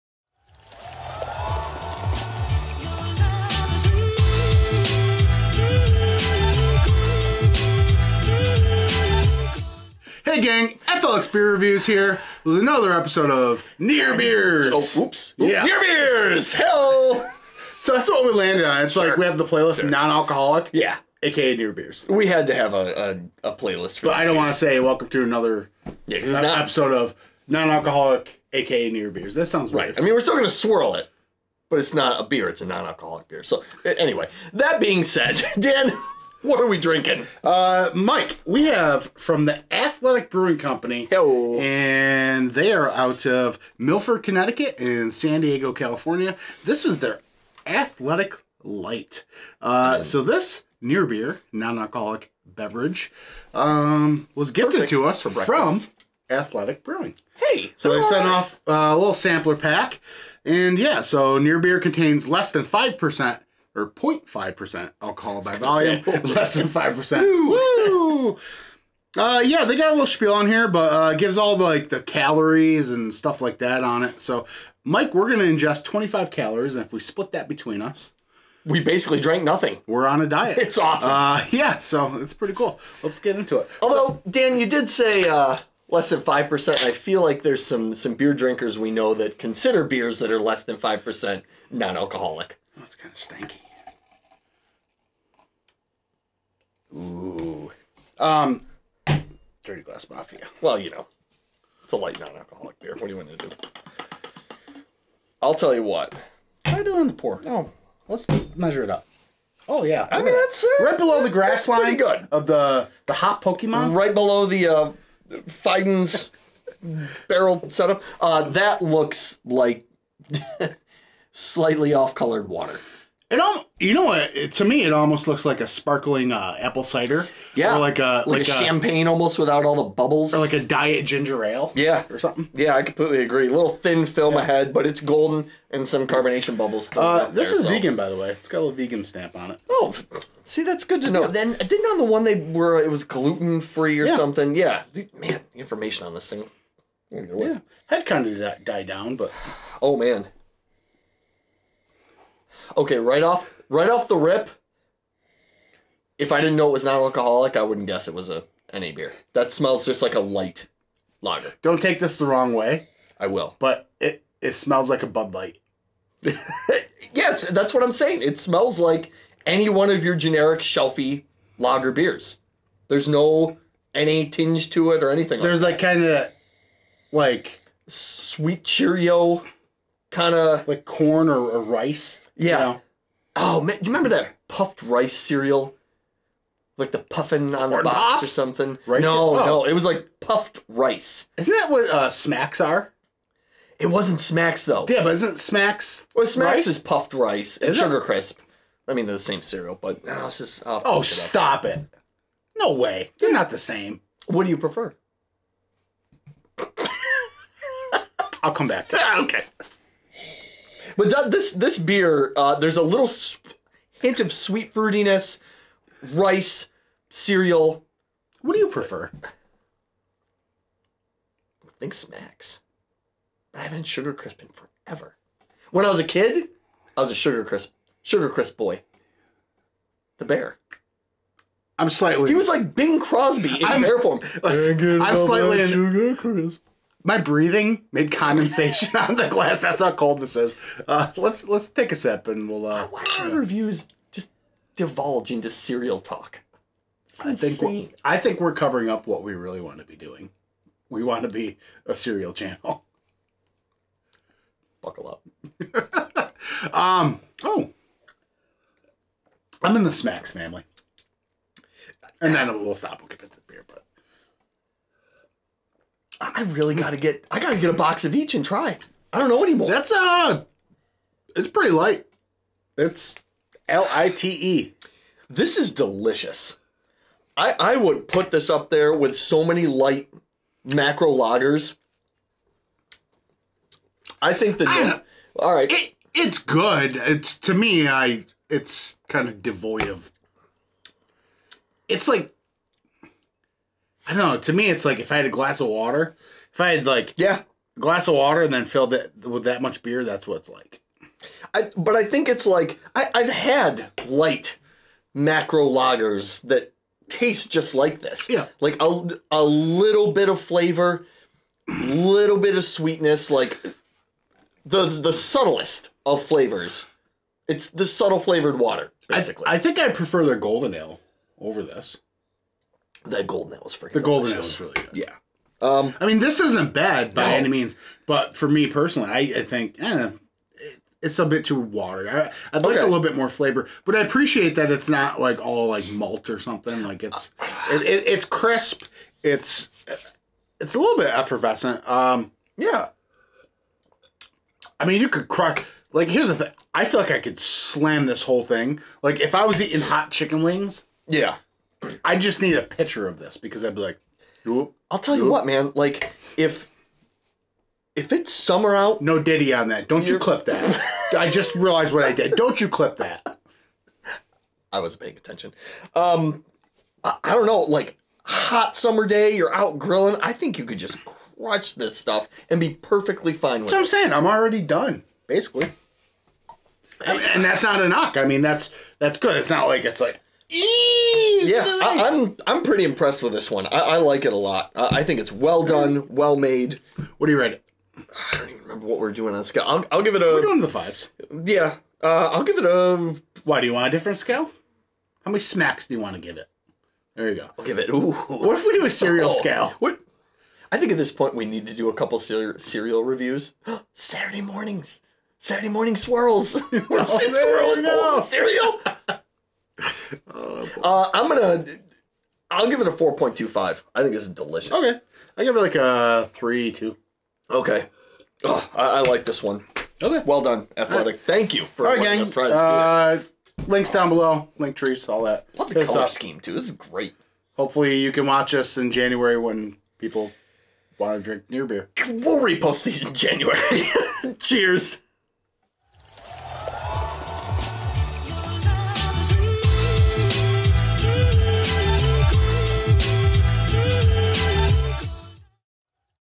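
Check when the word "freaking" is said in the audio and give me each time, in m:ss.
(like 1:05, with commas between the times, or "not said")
5:23.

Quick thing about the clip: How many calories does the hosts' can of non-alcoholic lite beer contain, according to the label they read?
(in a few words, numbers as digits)
25.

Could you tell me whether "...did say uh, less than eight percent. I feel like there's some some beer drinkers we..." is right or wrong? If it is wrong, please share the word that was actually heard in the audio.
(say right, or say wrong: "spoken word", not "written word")
wrong: "five", not "eight".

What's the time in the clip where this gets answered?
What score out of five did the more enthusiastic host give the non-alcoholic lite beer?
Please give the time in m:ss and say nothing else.
6:52.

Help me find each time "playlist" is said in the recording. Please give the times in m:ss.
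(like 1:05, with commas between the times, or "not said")
0:19, 0:23.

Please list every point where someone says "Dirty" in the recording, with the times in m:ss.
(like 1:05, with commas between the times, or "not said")
1:39.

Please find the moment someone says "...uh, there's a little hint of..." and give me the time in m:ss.
3:32.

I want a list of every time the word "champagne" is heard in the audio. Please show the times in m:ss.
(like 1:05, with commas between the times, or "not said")
2:08.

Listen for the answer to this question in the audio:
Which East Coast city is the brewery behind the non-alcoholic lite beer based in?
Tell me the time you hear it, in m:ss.
0:43.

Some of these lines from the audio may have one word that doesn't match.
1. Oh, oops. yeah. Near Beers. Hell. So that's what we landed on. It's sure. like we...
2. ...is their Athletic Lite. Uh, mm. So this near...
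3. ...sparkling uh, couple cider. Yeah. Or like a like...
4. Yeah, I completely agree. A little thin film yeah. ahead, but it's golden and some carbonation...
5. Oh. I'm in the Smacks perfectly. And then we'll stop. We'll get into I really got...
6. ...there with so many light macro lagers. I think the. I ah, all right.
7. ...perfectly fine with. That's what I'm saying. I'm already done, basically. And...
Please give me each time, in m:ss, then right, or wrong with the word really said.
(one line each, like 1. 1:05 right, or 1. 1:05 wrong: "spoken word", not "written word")
1. 0:14 right
2. 0:46 right
3. 2:05 wrong: "apple", not "couple"
4. 2:12 right
5. 4:17 wrong: "family", not "perfectly"
6. 4:38 right
7. 6:12 right.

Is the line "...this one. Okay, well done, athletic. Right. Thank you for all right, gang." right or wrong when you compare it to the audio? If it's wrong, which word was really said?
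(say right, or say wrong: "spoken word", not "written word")
right.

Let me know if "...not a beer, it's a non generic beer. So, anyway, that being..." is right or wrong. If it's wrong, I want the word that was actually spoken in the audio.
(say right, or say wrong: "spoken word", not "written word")
wrong: "alcoholic", not "generic".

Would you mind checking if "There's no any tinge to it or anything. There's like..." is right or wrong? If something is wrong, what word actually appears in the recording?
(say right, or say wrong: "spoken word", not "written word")
right.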